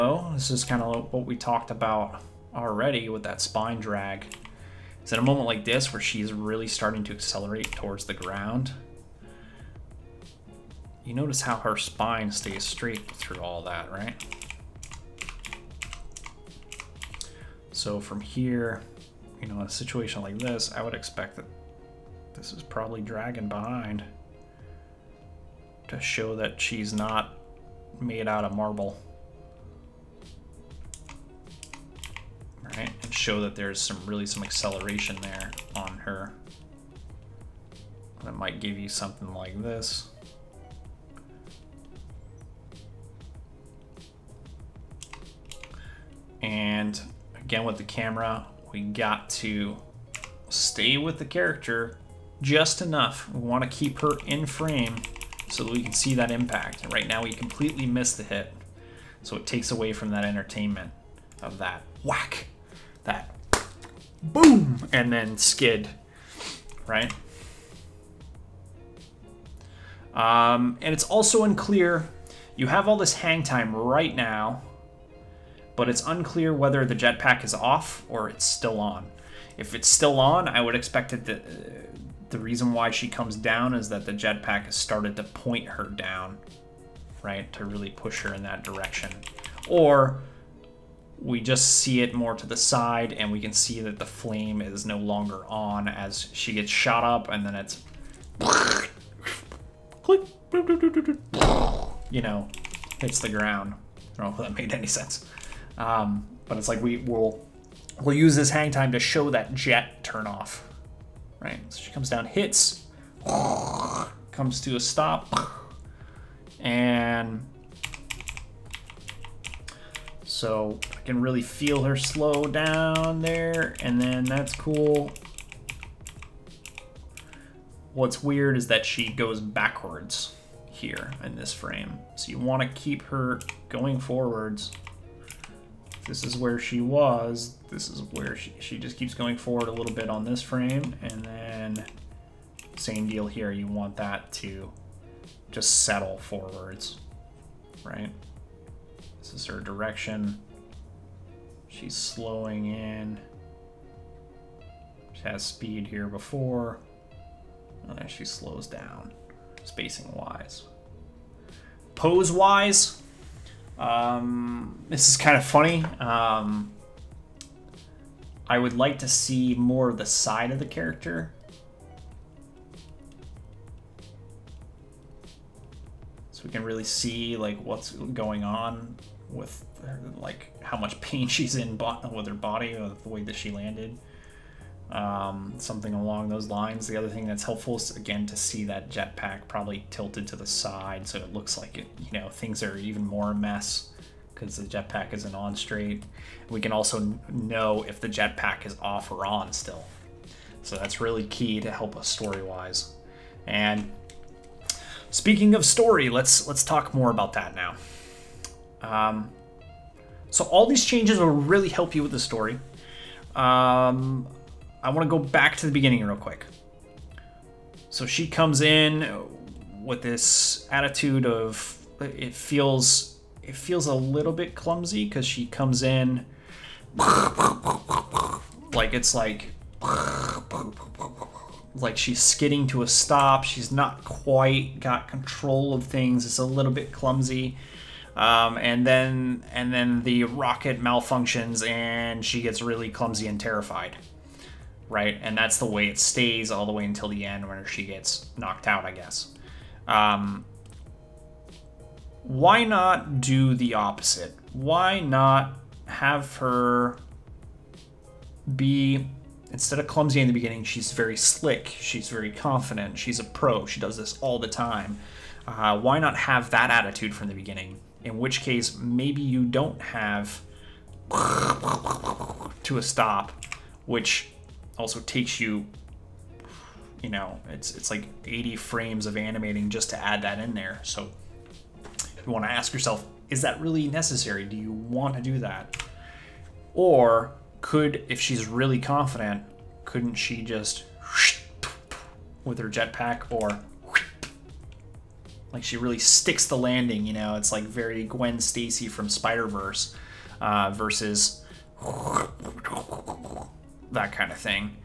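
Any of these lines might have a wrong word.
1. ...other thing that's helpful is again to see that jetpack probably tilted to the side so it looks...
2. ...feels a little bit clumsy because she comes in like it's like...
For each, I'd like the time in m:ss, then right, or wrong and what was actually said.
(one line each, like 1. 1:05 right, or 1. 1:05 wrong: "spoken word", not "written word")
1. 3:06 right
2. 3:43 right.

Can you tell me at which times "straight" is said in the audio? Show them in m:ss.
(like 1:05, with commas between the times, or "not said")
0:12, 3:15.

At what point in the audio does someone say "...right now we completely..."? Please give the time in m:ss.
0:56.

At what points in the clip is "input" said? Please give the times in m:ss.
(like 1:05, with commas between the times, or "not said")
not said.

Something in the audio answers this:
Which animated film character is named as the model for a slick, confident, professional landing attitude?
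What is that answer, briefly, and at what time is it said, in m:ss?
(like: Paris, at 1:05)
Gwen Stacy, at 4:58.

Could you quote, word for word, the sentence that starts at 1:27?
To really push her in that direction.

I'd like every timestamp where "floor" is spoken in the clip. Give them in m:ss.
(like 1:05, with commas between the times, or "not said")
not said.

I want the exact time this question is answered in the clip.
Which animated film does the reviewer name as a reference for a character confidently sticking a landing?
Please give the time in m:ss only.
4:59.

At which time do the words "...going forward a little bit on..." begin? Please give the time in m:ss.
2:19.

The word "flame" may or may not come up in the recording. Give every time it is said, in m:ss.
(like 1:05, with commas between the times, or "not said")
1:34.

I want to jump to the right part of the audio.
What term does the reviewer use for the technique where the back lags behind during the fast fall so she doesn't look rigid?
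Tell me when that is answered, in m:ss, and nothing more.
0:03.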